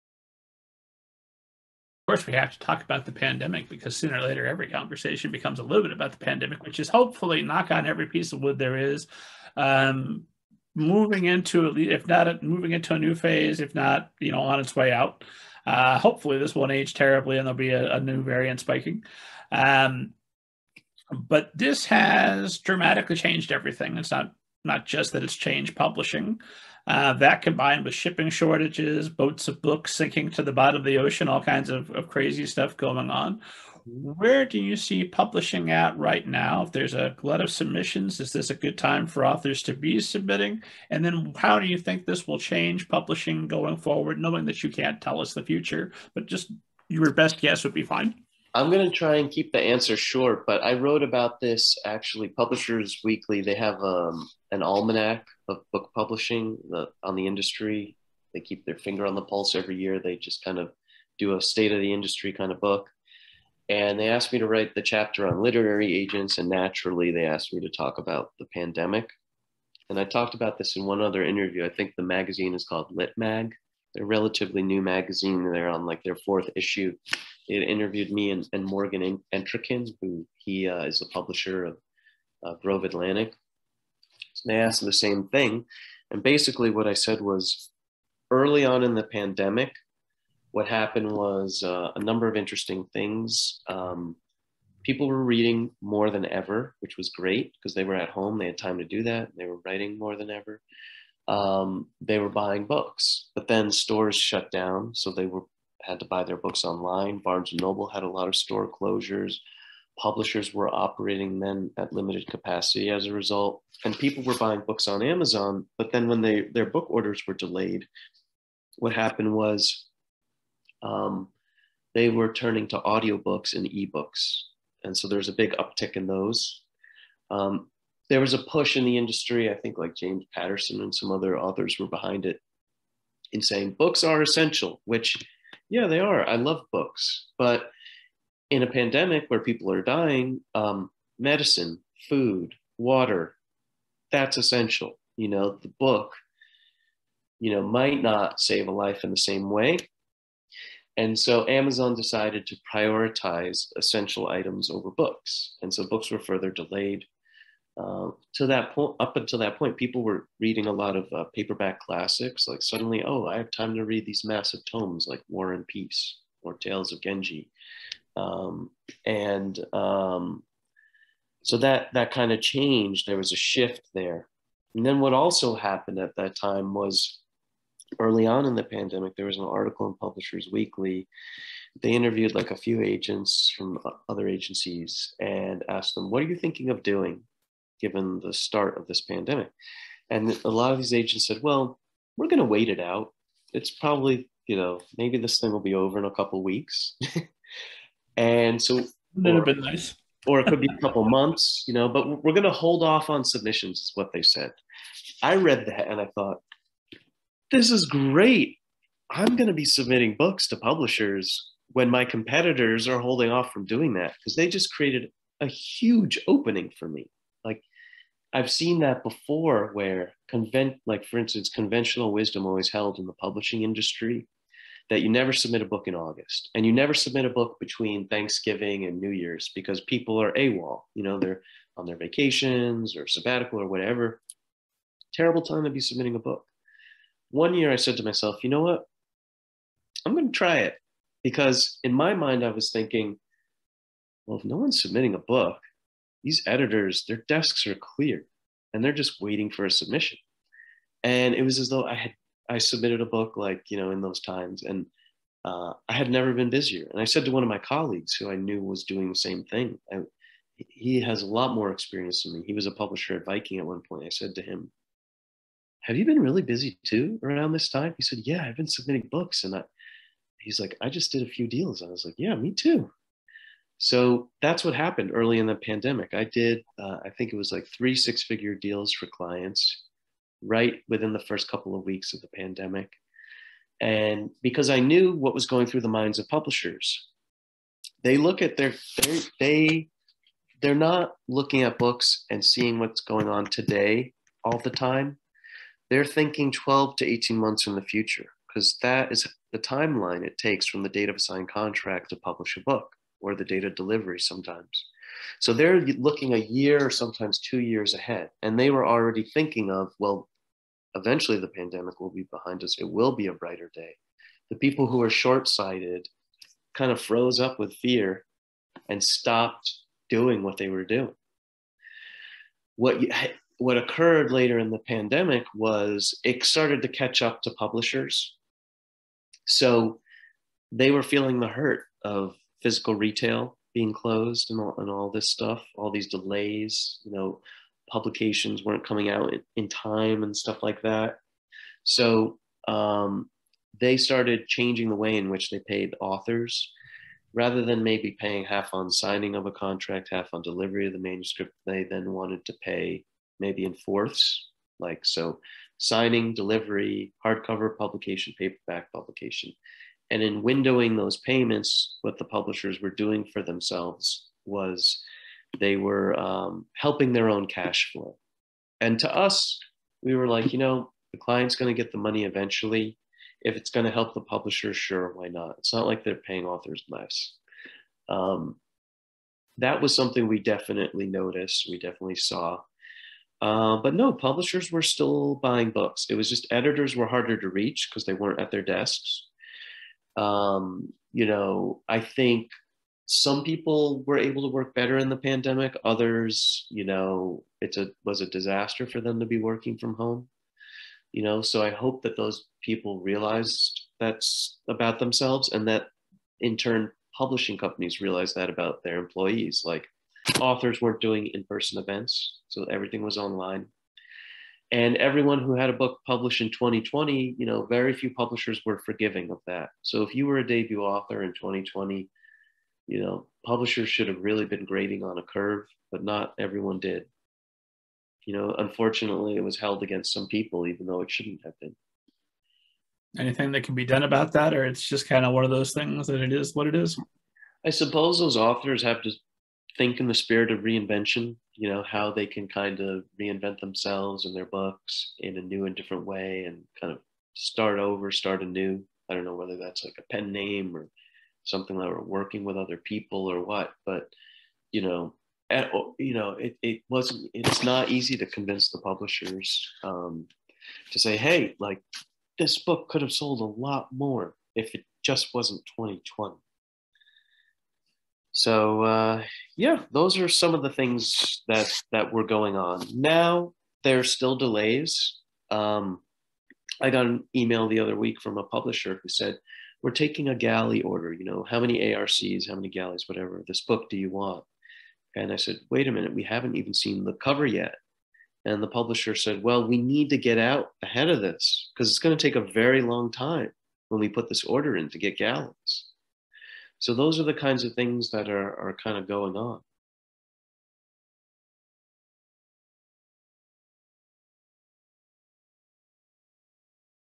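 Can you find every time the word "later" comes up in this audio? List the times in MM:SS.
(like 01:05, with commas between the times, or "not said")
00:04, 05:24.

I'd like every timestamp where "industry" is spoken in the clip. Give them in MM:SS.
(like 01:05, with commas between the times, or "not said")
00:57, 01:01, 02:08, 03:43.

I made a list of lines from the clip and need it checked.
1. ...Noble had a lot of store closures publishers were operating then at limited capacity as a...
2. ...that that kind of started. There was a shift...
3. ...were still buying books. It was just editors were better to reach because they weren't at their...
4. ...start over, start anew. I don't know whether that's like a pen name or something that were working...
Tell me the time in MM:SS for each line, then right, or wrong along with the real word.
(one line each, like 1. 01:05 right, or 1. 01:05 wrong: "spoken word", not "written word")
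1. 01:47 right
2. 02:51 wrong: "changed", not "started"
3. 06:24 wrong: "harder", not "better"
4. 07:27 right.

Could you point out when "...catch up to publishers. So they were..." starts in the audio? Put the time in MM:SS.
05:26.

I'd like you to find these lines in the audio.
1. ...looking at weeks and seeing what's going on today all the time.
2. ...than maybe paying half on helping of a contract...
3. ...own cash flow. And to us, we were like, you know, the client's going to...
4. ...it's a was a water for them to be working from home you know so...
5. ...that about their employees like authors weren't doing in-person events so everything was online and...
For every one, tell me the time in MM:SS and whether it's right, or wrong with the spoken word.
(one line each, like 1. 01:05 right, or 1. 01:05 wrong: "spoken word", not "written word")
1. 04:51 wrong: "books", not "weeks"
2. 05:47 wrong: "signing", not "helping"
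3. 06:07 right
4. 06:37 wrong: "disaster", not "water"
5. 06:48 right.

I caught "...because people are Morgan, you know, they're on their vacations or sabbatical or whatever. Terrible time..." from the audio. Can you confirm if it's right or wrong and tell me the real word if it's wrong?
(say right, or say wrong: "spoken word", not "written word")
wrong: "AWOL", not "Morgan".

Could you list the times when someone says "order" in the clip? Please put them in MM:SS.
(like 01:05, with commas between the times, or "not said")
01:56, 08:00, 08:14.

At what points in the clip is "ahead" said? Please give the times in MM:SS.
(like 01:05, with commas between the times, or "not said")
05:07, 08:10.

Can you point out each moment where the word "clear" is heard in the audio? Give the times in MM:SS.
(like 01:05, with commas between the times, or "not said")
04:07.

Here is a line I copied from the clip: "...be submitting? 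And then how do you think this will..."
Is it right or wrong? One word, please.
right.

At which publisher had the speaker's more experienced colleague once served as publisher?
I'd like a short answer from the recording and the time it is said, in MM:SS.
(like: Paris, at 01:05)
Viking, at 04:23.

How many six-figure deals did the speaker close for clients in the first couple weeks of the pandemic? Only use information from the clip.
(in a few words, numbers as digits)
3.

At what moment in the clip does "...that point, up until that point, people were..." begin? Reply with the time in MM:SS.
02:38.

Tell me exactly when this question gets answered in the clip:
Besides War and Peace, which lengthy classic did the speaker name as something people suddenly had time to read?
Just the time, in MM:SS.
02:46.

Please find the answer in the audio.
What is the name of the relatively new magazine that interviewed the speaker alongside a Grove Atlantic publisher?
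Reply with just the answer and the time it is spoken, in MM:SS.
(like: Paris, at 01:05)
Lit Mag, at 01:12.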